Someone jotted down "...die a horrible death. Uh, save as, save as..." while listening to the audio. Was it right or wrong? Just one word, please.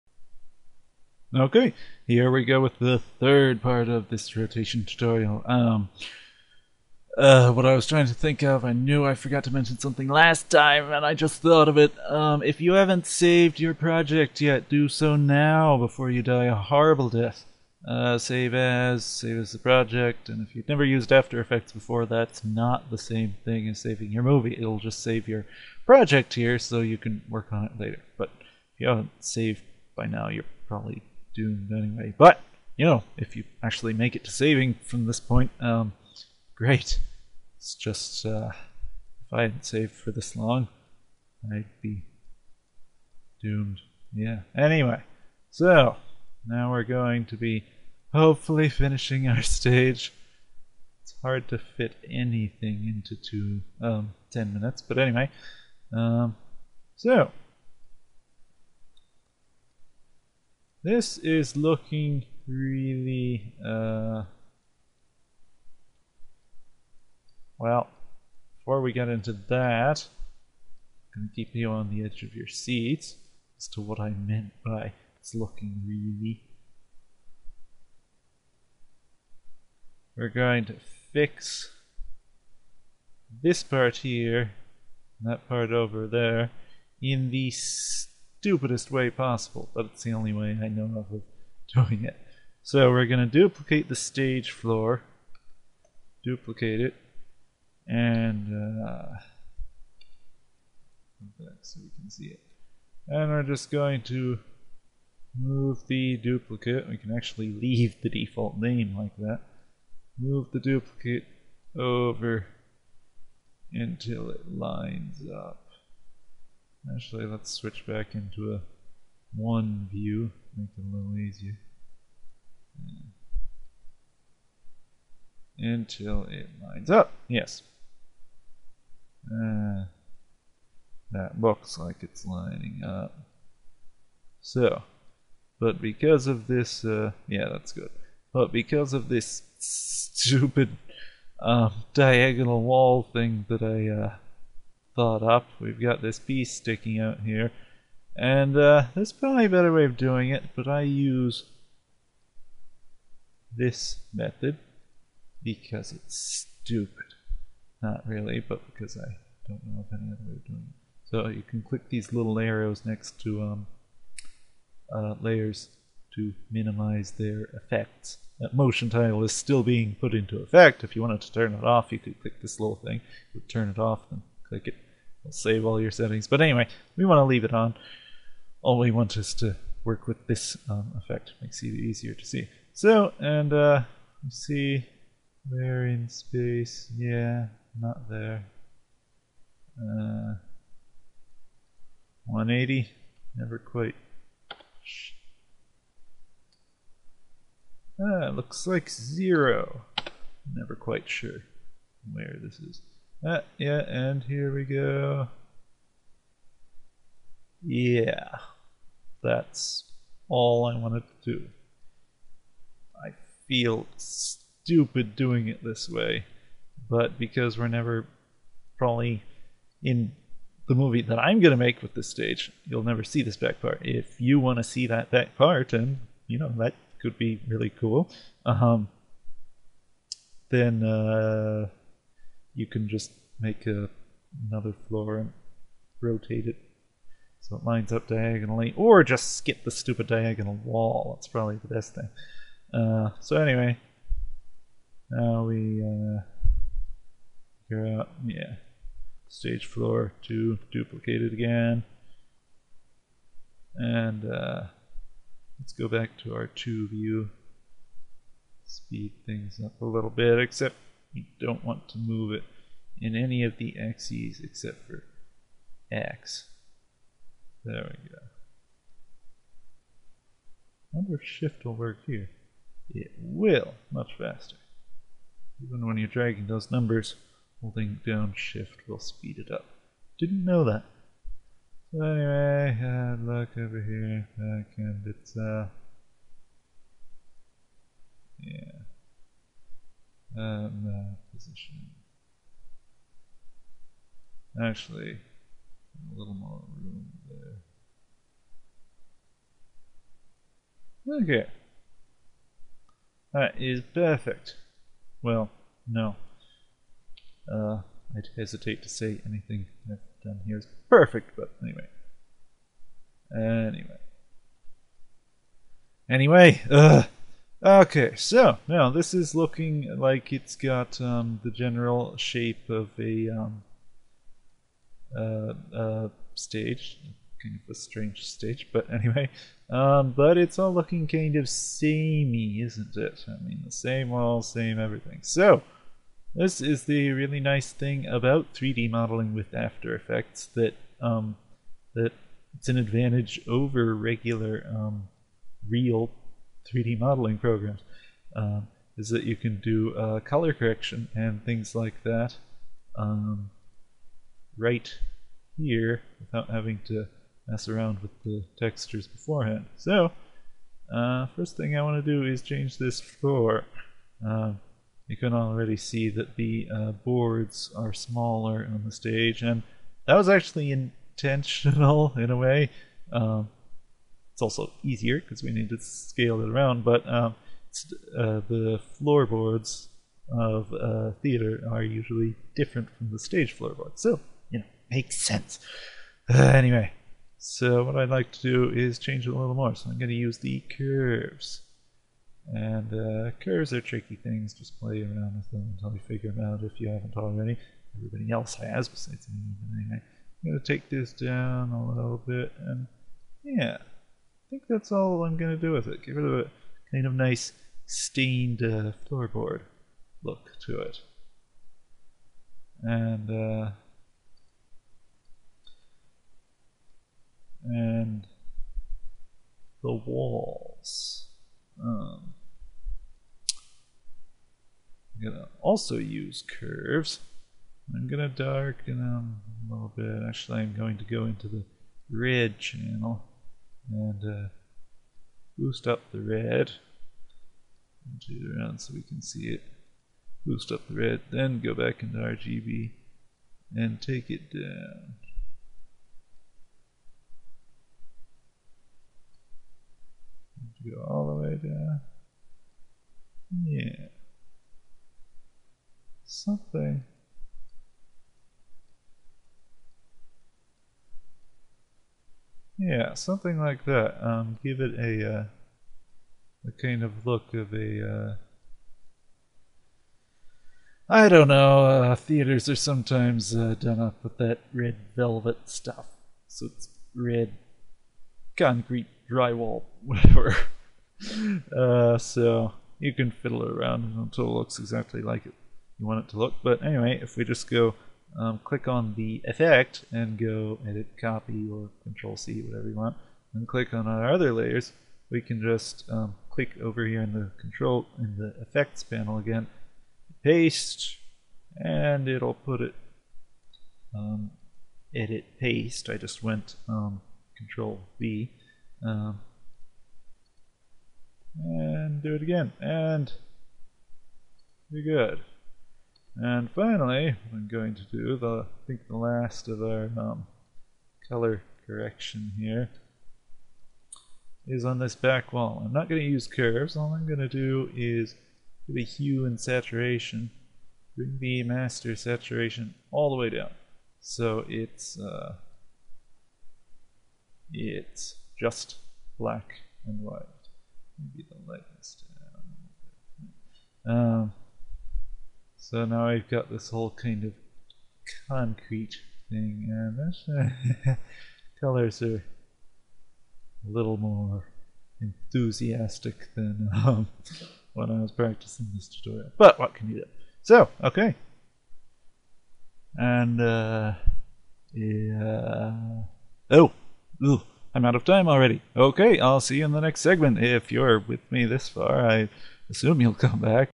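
right.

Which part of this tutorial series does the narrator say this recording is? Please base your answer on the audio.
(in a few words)
third.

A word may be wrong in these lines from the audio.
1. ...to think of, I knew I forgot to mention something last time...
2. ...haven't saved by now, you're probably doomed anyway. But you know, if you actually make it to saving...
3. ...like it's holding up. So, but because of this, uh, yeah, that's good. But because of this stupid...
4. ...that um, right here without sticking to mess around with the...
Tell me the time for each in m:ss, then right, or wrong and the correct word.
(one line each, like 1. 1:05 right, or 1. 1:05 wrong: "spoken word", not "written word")
1. 0:08 right
2. 0:28 right
3. 2:11 wrong: "lining", not "holding"
4. 5:52 wrong: "having", not "sticking".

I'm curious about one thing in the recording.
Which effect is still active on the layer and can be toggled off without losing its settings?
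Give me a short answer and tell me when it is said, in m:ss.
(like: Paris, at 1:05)
Motion Tile, at 2:48.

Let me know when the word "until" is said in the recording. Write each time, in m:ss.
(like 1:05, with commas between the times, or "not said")
1:53, 2:05, 6:35, 8:04.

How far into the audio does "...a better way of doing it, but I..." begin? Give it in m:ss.
2:29.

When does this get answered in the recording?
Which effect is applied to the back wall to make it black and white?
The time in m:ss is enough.
8:49.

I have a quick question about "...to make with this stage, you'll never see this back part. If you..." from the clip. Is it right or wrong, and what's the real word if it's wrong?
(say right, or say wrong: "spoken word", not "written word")
right.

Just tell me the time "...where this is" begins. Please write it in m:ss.
3:22.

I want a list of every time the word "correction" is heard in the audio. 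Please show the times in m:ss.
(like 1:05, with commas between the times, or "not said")
5:50, 8:41.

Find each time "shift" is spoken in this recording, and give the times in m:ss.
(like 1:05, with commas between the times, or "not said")
4:31, 4:38.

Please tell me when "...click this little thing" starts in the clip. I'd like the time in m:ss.
2:52.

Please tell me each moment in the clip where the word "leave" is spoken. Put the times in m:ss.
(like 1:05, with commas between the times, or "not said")
1:47, 2:57.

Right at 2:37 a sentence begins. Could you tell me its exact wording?
Not really, but because I don't know of any other way of doing it.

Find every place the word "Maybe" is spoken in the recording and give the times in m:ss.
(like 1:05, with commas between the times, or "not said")
9:01.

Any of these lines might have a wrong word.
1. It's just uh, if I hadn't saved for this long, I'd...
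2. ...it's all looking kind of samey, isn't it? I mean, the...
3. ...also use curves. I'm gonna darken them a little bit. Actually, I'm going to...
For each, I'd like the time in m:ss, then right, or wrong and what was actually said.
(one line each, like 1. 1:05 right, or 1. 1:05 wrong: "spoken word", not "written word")
1. 0:37 right
2. 5:30 right
3. 7:05 right.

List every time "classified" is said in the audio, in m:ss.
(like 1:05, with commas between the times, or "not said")
not said.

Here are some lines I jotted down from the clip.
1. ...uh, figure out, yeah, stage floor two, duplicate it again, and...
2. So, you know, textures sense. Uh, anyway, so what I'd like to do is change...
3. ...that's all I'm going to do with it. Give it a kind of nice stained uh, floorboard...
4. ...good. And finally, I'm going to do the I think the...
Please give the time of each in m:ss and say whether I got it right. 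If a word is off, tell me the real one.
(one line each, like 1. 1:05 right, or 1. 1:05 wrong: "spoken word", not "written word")
1. 4:05 right
2. 6:24 wrong: "makes", not "textures"
3. 6:44 right
4. 8:35 right.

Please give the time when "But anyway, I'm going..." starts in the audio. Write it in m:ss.
6:39.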